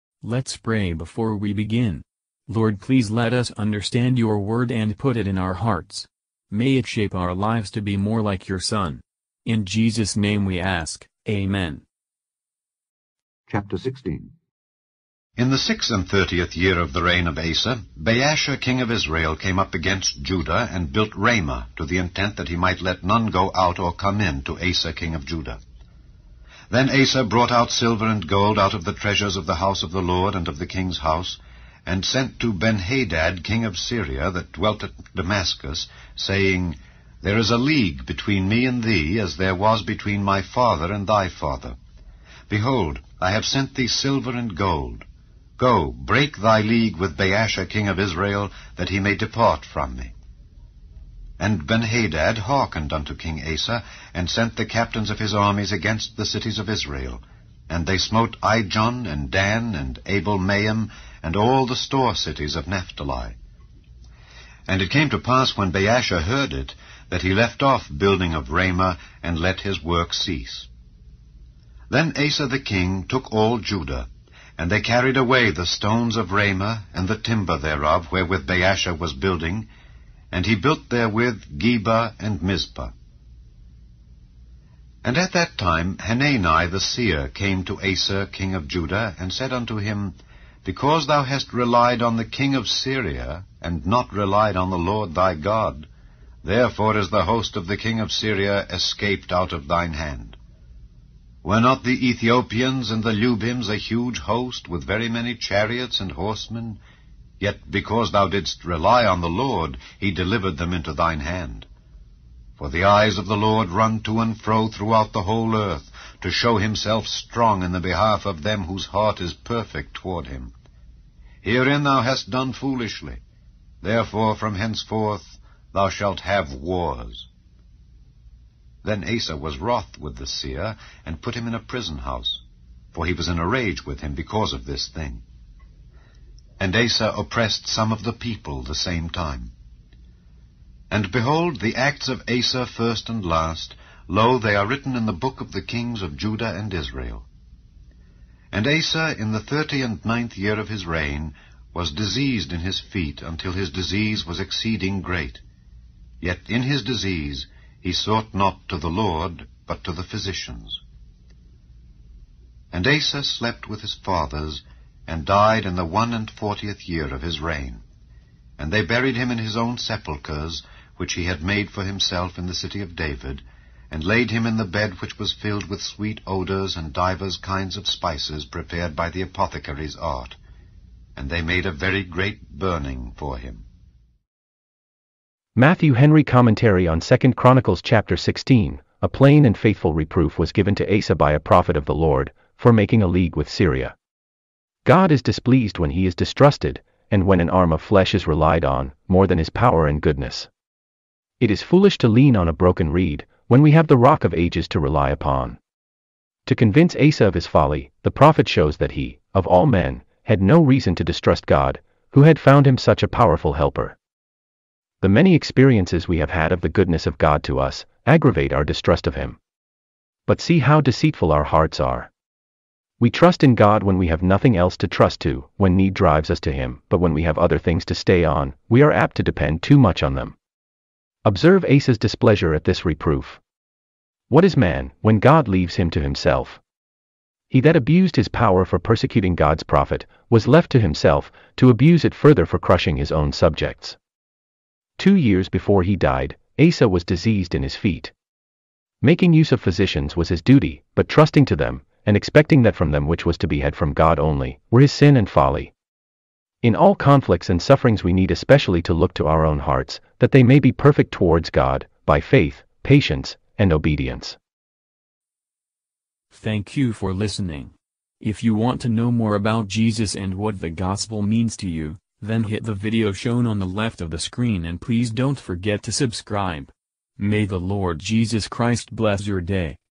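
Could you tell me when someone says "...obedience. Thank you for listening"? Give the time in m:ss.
4:23.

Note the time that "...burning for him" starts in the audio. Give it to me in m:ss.
3:02.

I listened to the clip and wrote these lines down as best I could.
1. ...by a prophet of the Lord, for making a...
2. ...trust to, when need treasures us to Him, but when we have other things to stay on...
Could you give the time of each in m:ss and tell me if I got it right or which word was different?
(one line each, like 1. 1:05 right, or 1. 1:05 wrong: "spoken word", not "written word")
1. 3:11 right
2. 3:44 wrong: "drives", not "treasures".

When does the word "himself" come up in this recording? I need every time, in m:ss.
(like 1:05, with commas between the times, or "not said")
1:56, 2:51, 3:55, 4:00.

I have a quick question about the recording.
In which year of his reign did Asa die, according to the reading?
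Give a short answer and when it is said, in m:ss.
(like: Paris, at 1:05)
41, at 2:45.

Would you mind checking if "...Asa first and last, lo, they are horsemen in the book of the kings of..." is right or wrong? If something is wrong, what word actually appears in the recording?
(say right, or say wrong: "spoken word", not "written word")
wrong: "written", not "horsemen".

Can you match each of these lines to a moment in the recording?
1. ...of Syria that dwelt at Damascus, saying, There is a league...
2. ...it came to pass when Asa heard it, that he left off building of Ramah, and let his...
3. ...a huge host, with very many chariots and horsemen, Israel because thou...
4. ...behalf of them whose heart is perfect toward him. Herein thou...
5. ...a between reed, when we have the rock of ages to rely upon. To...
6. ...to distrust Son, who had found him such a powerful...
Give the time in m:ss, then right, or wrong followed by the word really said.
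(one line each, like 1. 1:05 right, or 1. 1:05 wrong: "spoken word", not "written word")
1. 0:33 right
2. 1:04 wrong: "Baasha", not "Asa"
3. 1:43 wrong: "Yet", not "Israel"
4. 1:57 right
5. 3:22 wrong: "broken", not "between"
6. 3:30 wrong: "God", not "Son".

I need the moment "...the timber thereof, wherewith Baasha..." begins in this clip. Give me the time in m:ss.
1:17.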